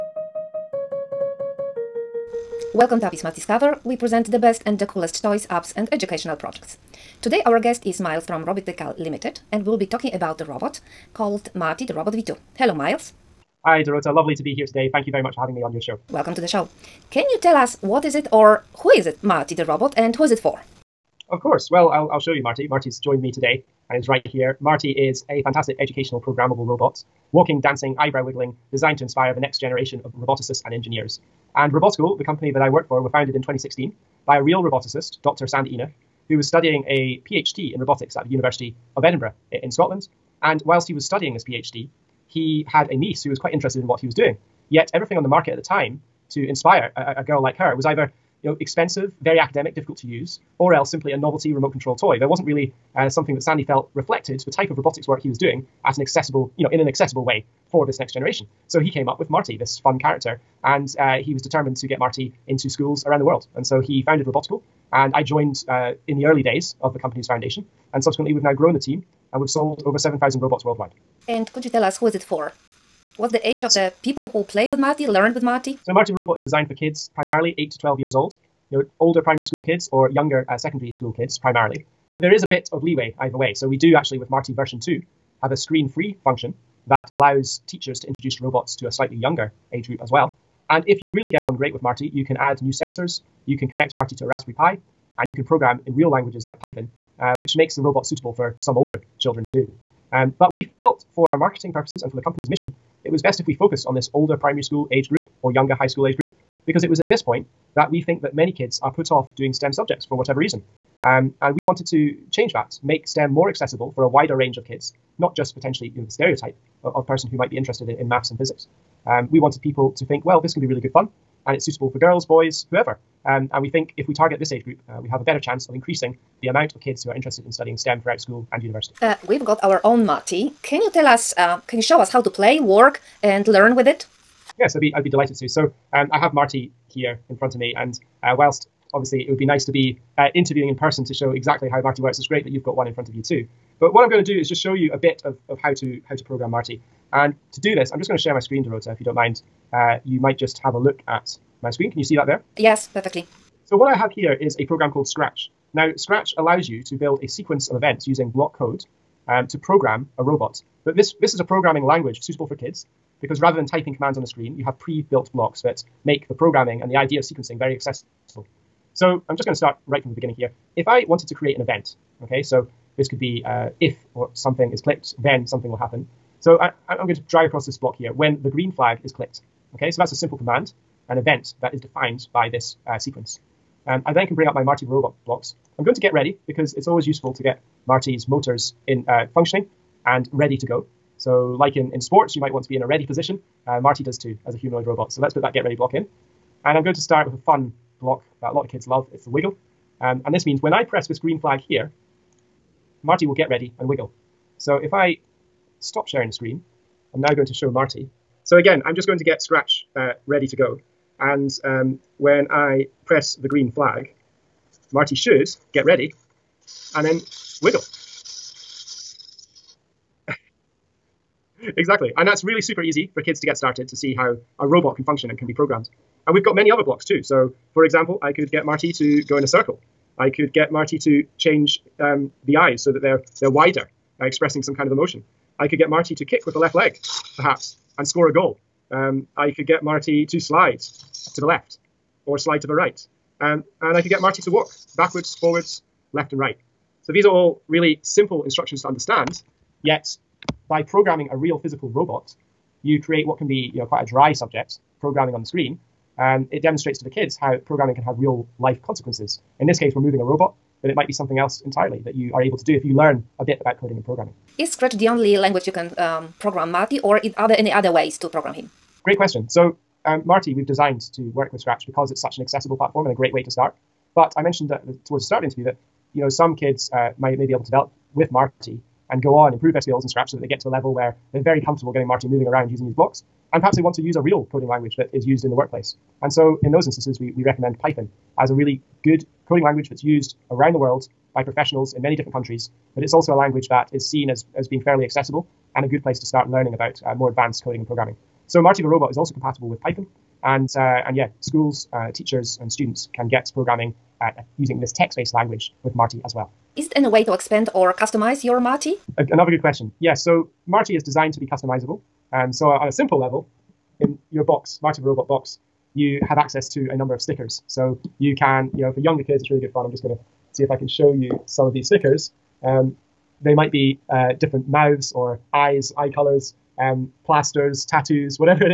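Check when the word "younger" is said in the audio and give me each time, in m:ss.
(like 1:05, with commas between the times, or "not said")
1:20, 1:29, 1:45, 5:18.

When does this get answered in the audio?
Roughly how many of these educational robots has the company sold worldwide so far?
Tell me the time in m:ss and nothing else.
1:09.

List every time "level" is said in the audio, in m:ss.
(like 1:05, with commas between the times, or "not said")
4:40, 5:13.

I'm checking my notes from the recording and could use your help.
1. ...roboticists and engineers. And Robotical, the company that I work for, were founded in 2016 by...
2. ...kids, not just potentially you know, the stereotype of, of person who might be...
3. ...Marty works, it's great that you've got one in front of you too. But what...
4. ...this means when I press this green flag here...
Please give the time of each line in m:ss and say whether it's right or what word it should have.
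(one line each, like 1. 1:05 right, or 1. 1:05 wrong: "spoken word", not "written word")
1. 0:30 right
2. 1:54 right
3. 2:21 right
4. 3:20 right.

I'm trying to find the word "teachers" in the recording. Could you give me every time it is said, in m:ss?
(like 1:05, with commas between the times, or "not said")
1:27, 5:02.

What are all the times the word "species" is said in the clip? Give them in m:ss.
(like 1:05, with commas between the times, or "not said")
not said.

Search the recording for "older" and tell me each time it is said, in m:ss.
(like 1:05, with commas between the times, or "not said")
1:18, 1:38, 1:44.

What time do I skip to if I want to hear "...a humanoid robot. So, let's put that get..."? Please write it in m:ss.
3:14.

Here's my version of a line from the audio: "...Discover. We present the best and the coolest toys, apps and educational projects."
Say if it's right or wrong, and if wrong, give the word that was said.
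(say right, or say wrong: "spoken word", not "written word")
right.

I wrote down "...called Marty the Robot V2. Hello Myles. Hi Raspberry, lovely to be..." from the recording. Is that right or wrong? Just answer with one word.
wrong.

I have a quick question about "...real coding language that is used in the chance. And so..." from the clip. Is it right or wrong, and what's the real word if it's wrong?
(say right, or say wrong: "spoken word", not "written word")
wrong: "workplace", not "chance".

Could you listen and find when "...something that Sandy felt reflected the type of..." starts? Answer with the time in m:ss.
0:53.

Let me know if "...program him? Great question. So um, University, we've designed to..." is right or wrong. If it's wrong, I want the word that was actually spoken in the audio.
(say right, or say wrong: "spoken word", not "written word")
wrong: "Marty", not "University".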